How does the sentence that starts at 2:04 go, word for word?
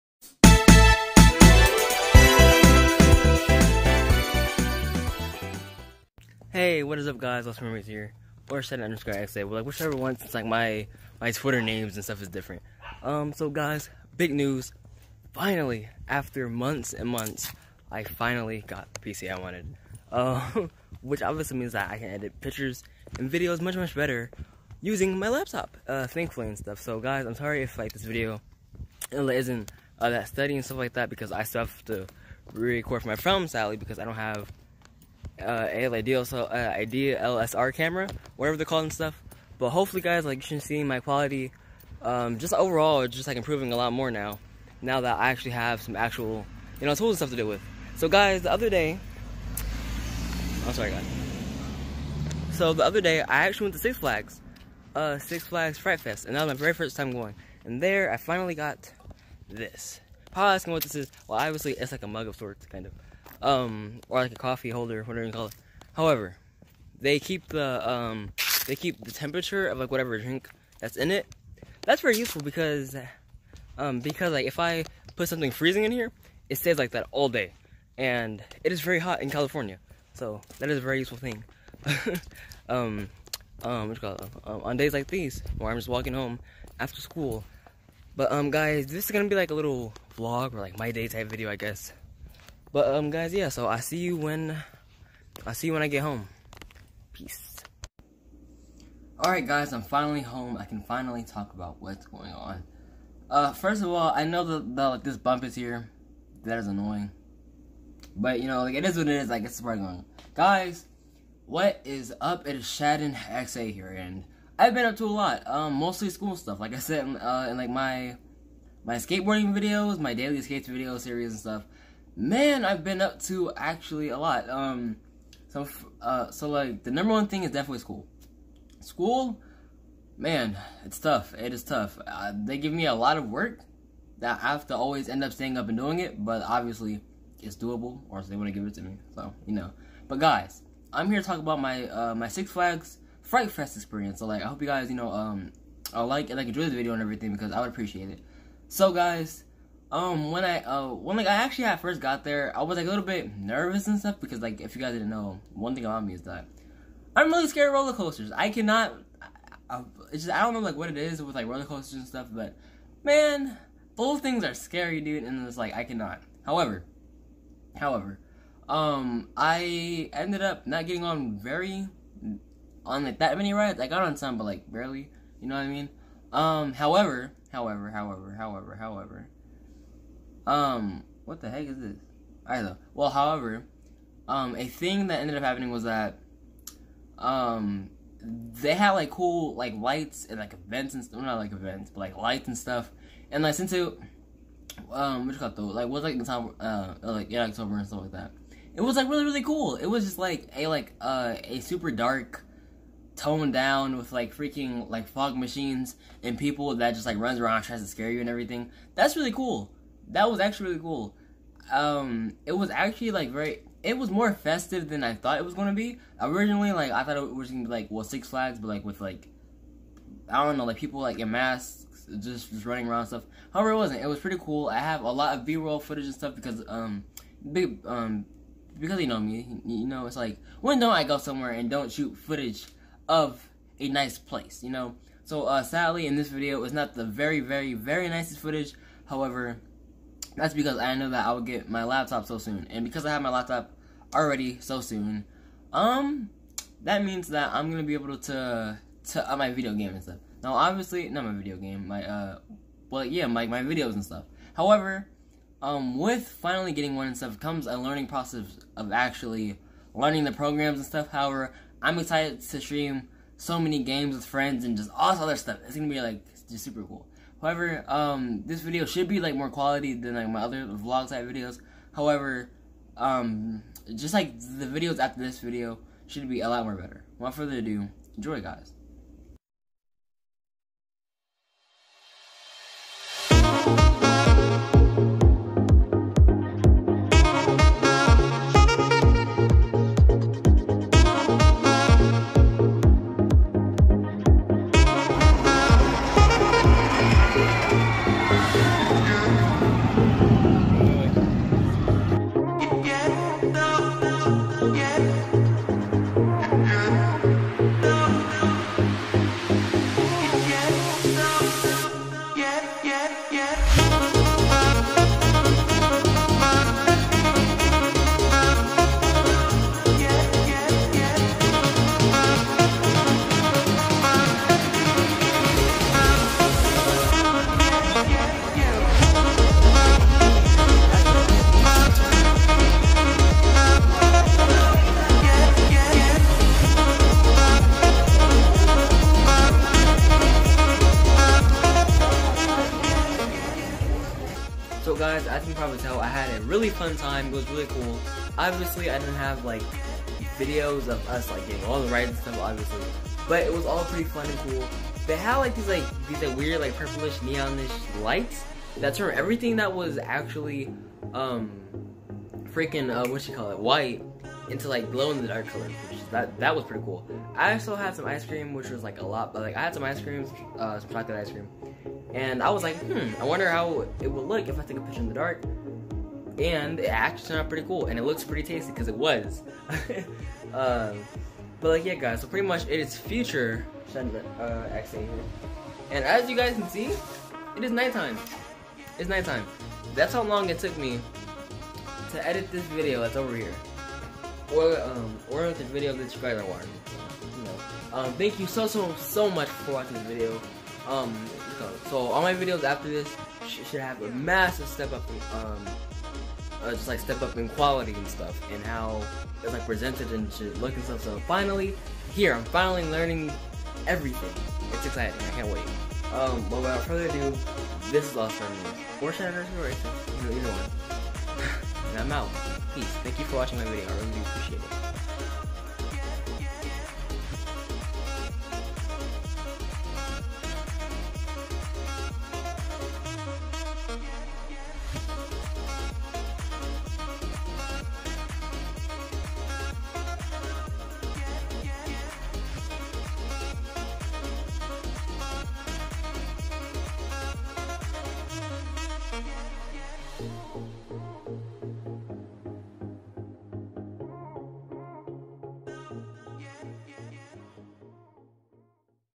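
Um, so, uh, so like the number one thing is definitely school.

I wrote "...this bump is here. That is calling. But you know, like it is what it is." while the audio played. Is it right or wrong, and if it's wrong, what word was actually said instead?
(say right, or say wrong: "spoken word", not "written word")
wrong: "annoying", not "calling".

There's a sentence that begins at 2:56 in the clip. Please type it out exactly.
Um, however, however, however, however, however, um, what the heck is this?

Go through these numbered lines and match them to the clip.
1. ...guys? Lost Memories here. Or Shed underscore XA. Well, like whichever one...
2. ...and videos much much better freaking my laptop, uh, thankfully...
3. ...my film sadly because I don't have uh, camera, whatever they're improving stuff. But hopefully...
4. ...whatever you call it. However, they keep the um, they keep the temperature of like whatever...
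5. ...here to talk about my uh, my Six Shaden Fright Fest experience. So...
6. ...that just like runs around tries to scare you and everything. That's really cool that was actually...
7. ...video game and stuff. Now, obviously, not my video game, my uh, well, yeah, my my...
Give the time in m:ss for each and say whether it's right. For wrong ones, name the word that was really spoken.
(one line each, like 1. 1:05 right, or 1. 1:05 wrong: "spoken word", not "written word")
1. 0:07 right
2. 0:23 wrong: "using", not "freaking"
3. 0:33 wrong: "calling", not "improving"
4. 1:05 right
5. 2:21 wrong: "Flags", not "Shaden"
6. 3:26 right
7. 4:09 right.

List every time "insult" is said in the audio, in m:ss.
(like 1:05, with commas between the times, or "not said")
not said.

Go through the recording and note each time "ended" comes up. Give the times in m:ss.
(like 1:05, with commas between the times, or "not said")
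2:50, 3:05.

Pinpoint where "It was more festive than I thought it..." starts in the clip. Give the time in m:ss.
3:33.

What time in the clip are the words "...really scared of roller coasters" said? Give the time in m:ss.
2:37.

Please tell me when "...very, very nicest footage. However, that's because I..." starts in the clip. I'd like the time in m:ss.
3:57.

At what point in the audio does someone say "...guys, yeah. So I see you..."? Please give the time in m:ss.
1:33.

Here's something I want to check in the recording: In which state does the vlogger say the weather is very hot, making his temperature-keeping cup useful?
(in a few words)
California.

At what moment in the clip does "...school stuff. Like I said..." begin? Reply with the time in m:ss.
1:56.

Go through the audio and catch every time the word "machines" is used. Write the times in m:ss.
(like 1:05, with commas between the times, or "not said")
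3:25.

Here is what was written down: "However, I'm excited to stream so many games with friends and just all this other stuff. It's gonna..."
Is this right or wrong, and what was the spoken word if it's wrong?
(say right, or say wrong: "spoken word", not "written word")
right.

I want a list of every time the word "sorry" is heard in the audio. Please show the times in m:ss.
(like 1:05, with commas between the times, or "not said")
0:27, 0:50.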